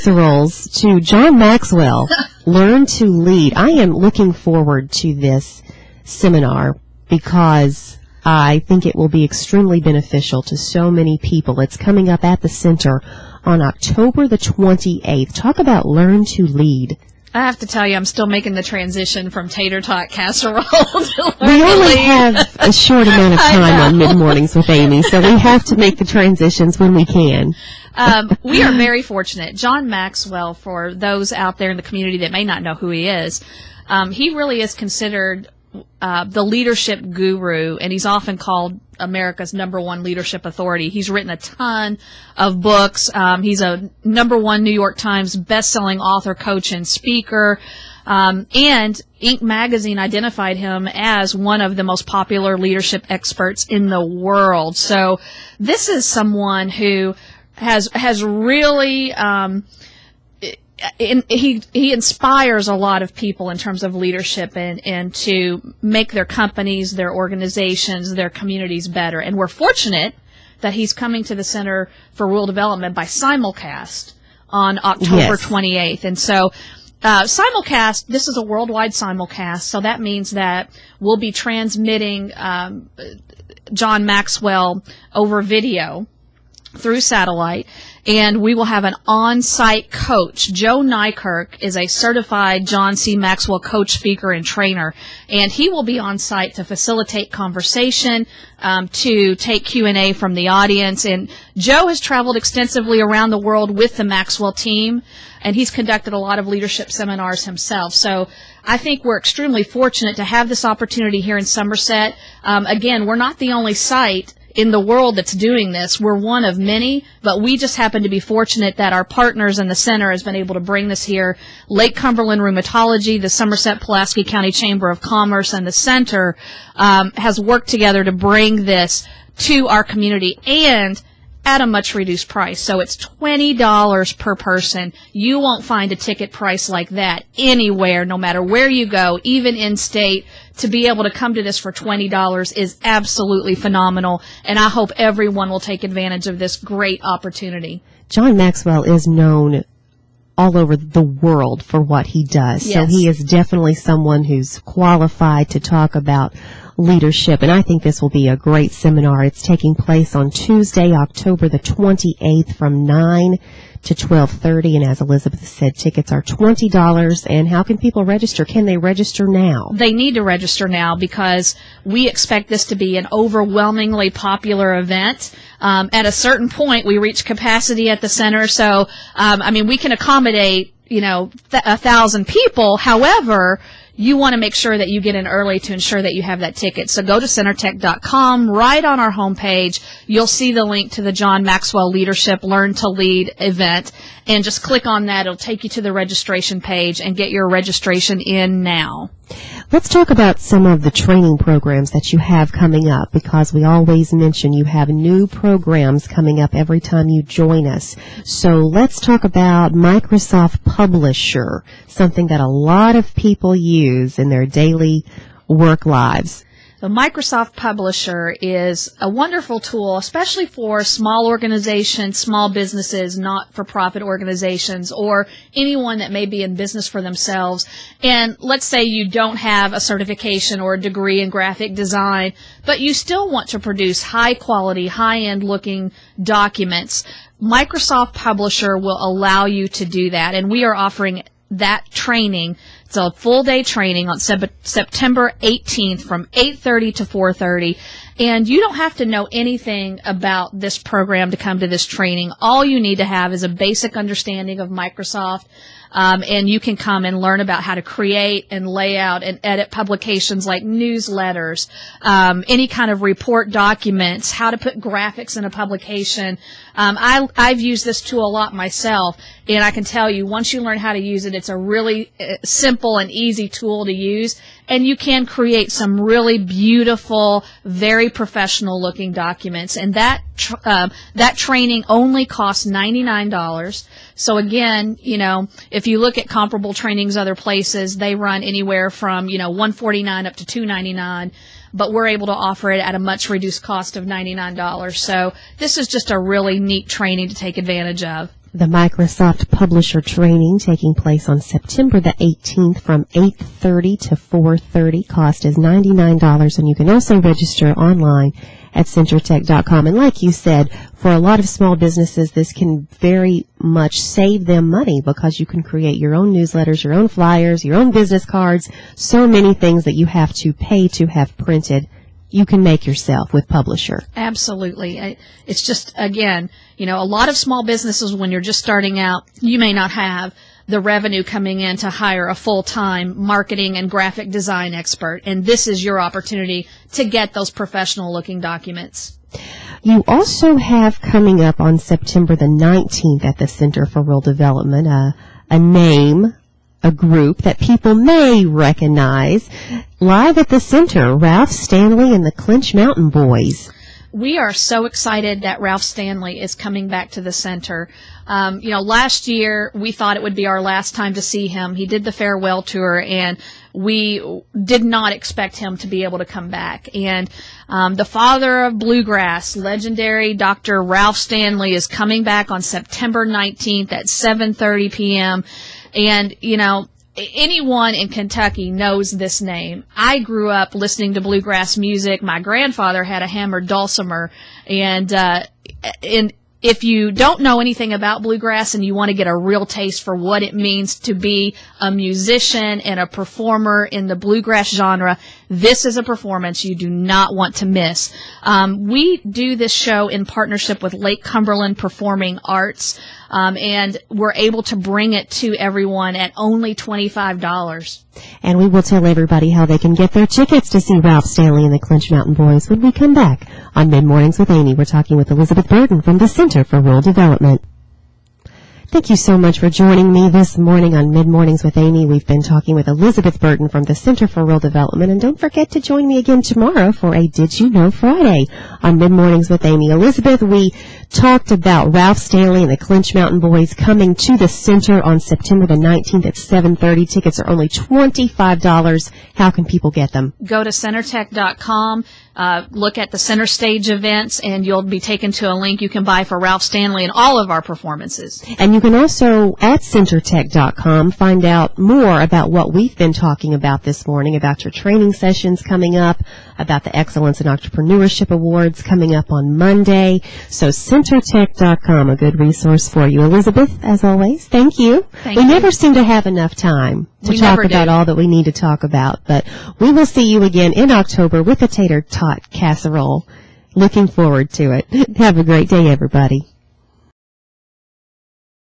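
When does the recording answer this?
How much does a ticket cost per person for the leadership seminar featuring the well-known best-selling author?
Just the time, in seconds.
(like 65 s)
133 s.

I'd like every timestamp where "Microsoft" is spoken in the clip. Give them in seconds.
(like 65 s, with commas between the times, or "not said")
209 s, 216 s, 237 s, 254 s, 298 s.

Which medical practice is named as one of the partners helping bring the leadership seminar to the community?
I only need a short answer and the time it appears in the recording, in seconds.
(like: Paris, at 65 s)
Lake Cumberland Rheumatology, at 121 s.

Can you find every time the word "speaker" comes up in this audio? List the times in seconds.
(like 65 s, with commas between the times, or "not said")
46 s, 93 s.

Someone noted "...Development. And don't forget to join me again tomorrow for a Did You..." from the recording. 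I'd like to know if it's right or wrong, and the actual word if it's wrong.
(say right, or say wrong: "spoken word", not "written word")
right.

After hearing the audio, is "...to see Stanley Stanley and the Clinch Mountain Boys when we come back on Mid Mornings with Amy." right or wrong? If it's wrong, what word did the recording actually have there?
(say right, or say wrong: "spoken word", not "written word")
wrong: "Ralph", not "Stanley".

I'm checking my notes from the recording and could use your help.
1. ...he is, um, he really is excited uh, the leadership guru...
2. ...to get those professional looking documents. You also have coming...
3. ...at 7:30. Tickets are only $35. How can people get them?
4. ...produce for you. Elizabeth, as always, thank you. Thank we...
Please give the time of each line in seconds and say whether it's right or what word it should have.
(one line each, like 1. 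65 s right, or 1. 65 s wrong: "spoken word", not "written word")
1. 32 s wrong: "considered", not "excited"
2. 336 s right
3. 436 s wrong: "25", not "35"
4. 462 s wrong: "resource", not "produce".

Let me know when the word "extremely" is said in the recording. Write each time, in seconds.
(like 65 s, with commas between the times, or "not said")
9 s, 109 s.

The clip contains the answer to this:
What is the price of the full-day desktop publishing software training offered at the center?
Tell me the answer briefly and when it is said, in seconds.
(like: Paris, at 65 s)
$99, at 282 s.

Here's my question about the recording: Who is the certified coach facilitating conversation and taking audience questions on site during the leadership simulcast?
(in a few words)
Joe Nykirk.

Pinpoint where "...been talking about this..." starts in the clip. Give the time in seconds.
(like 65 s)
452 s.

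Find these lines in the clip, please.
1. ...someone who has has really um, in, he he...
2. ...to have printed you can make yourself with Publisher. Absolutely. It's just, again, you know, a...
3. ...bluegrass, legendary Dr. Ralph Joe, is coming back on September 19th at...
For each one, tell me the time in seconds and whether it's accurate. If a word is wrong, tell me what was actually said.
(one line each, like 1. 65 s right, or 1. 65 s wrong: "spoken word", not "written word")
1. 56 s right
2. 320 s right
3. 368 s wrong: "Stanley", not "Joe".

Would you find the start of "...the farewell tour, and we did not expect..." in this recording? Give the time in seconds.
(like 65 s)
362 s.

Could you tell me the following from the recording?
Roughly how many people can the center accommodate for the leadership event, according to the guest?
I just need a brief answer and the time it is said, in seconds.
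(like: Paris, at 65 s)
1000, at 181 s.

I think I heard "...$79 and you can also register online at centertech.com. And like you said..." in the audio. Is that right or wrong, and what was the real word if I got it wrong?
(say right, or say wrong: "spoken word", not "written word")
wrong: "99", not "79".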